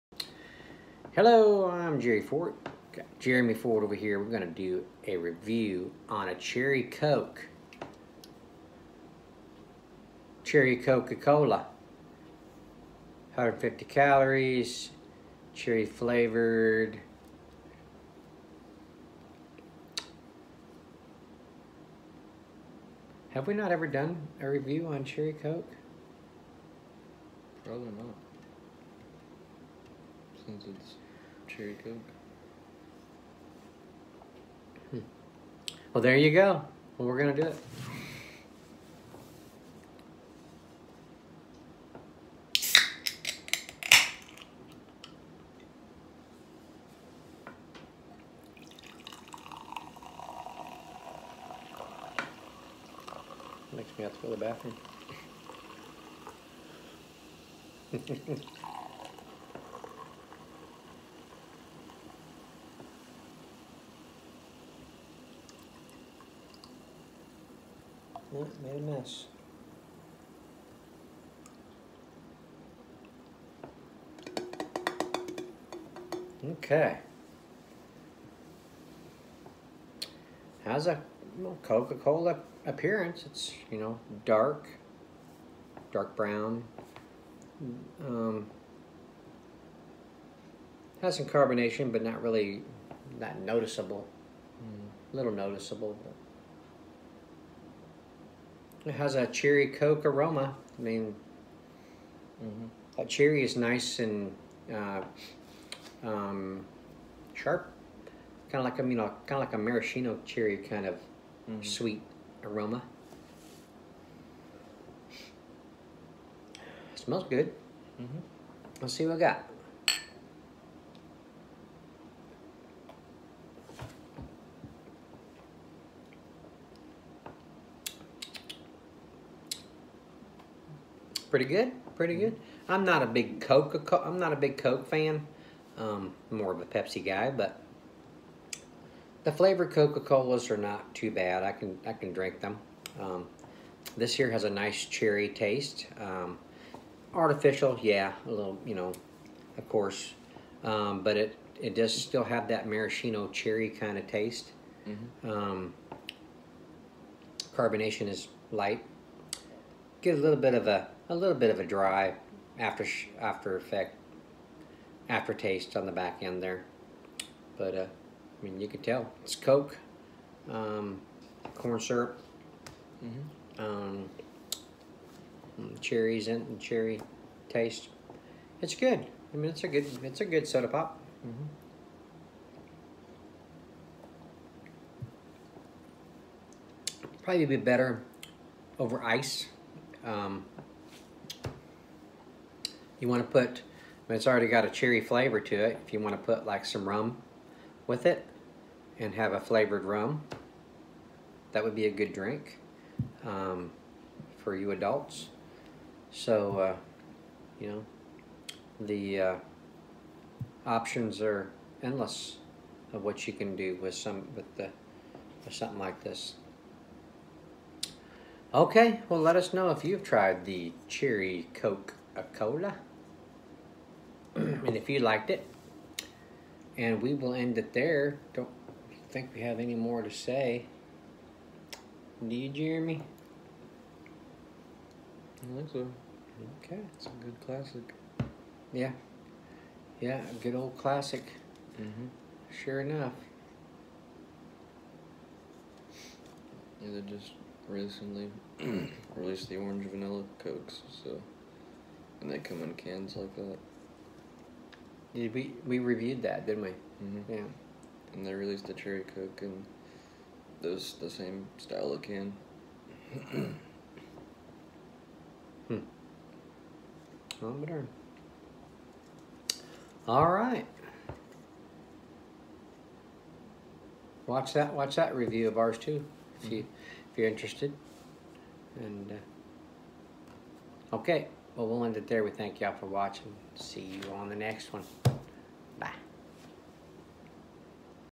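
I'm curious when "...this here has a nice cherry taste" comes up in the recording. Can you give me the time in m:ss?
2:23.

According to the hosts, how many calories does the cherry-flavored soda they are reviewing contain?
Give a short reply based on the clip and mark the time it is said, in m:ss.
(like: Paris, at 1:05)
150, at 0:13.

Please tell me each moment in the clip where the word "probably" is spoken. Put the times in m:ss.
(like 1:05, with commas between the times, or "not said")
0:27, 3:07.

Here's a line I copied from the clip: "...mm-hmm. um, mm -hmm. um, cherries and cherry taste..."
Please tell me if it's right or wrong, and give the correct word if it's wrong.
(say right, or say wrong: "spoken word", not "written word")
right.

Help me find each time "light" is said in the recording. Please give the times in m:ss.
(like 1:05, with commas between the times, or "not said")
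2:38.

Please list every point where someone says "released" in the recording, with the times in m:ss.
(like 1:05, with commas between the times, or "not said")
4:09, 4:18.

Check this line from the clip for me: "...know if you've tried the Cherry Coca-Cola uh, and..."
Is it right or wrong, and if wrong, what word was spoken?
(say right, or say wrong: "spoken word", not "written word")
right.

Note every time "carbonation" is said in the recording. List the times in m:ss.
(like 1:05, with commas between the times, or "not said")
1:31, 2:37.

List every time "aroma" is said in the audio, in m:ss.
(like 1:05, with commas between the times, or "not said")
1:40, 1:52.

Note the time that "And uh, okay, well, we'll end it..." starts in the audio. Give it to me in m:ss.
4:38.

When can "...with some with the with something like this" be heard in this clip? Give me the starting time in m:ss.
3:33.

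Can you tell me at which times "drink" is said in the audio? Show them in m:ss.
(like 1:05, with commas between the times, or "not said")
2:22, 3:22.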